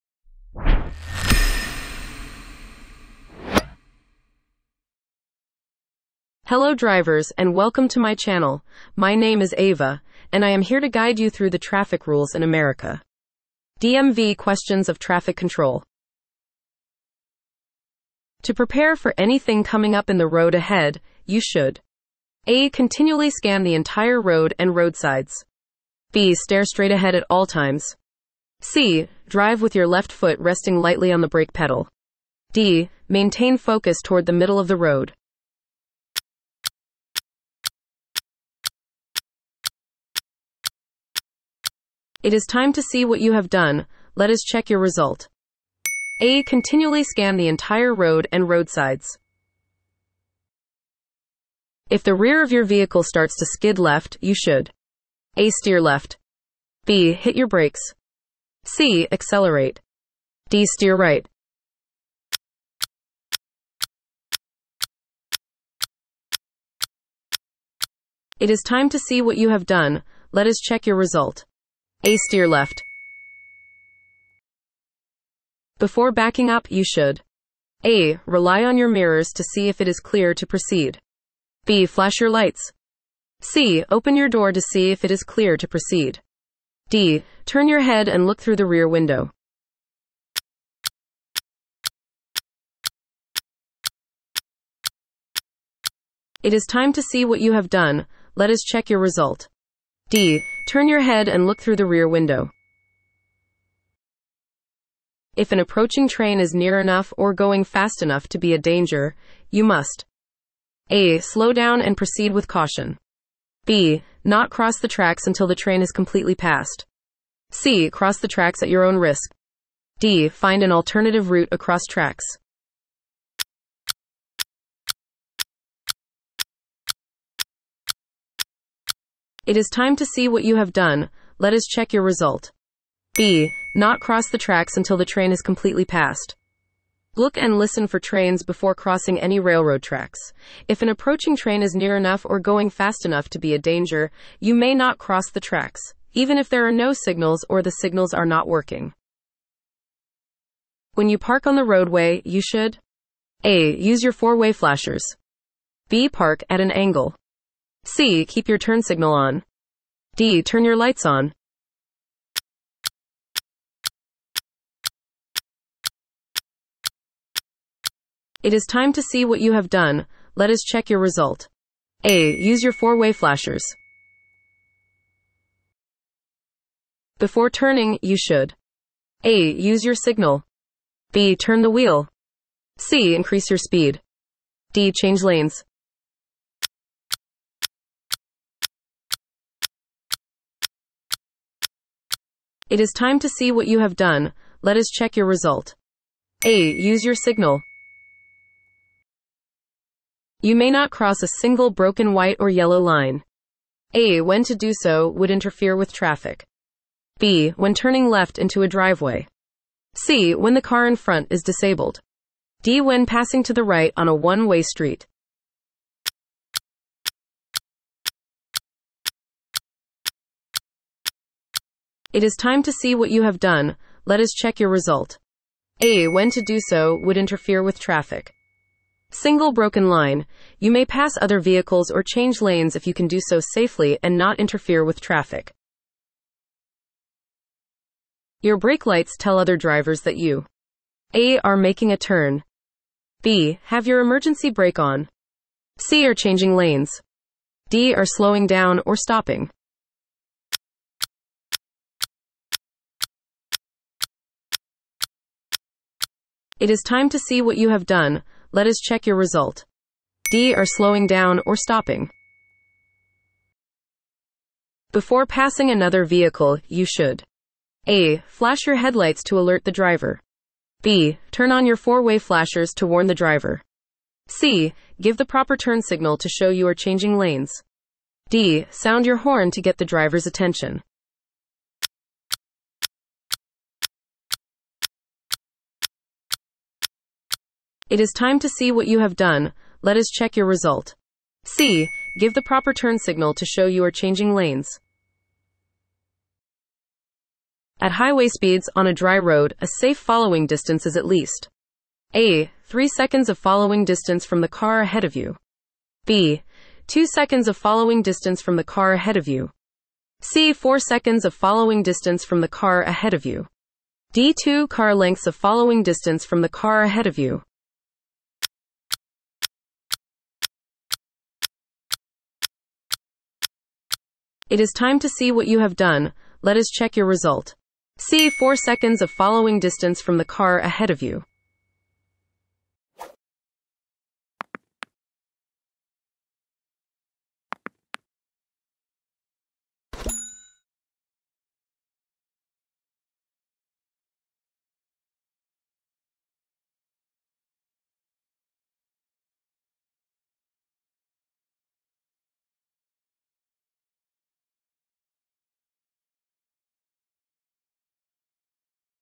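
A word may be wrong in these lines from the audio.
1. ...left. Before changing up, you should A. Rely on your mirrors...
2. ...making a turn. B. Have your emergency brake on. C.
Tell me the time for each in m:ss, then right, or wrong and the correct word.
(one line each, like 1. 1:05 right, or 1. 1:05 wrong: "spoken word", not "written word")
1. 1:12 wrong: "backing", not "changing"
2. 4:01 right.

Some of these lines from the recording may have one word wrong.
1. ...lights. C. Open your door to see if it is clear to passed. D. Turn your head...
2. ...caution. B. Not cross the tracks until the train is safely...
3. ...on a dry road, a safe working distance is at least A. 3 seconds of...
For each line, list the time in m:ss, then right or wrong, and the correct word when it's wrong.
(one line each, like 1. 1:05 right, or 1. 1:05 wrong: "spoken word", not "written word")
1. 1:22 wrong: "proceed", not "passed"
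2. 1:52 wrong: "completely", not "safely"
3. 4:58 wrong: "following", not "working".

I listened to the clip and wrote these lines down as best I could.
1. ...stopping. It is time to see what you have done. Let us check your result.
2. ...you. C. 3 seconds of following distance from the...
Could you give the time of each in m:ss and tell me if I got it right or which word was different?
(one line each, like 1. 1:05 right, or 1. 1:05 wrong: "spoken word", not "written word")
1. 4:08 right
2. 5:09 wrong: "4", not "3".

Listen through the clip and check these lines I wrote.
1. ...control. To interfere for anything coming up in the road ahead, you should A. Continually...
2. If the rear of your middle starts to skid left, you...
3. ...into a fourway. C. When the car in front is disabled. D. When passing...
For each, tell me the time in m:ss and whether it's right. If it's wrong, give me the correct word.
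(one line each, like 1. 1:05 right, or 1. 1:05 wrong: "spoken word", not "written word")
1. 0:15 wrong: "prepare", not "interfere"
2. 0:51 wrong: "vehicle", not "middle"
3. 3:28 wrong: "driveway", not "fourway".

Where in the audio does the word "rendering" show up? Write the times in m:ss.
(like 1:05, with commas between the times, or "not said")
not said.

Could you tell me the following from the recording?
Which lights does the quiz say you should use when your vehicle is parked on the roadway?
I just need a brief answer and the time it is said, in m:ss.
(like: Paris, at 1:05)
Four-way flashers, at 2:52.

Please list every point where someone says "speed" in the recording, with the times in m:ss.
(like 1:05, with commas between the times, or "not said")
3:03, 4:58.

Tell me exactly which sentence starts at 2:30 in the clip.
When you park on the roadway, you should A.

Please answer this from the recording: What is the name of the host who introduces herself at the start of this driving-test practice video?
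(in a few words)
Ava.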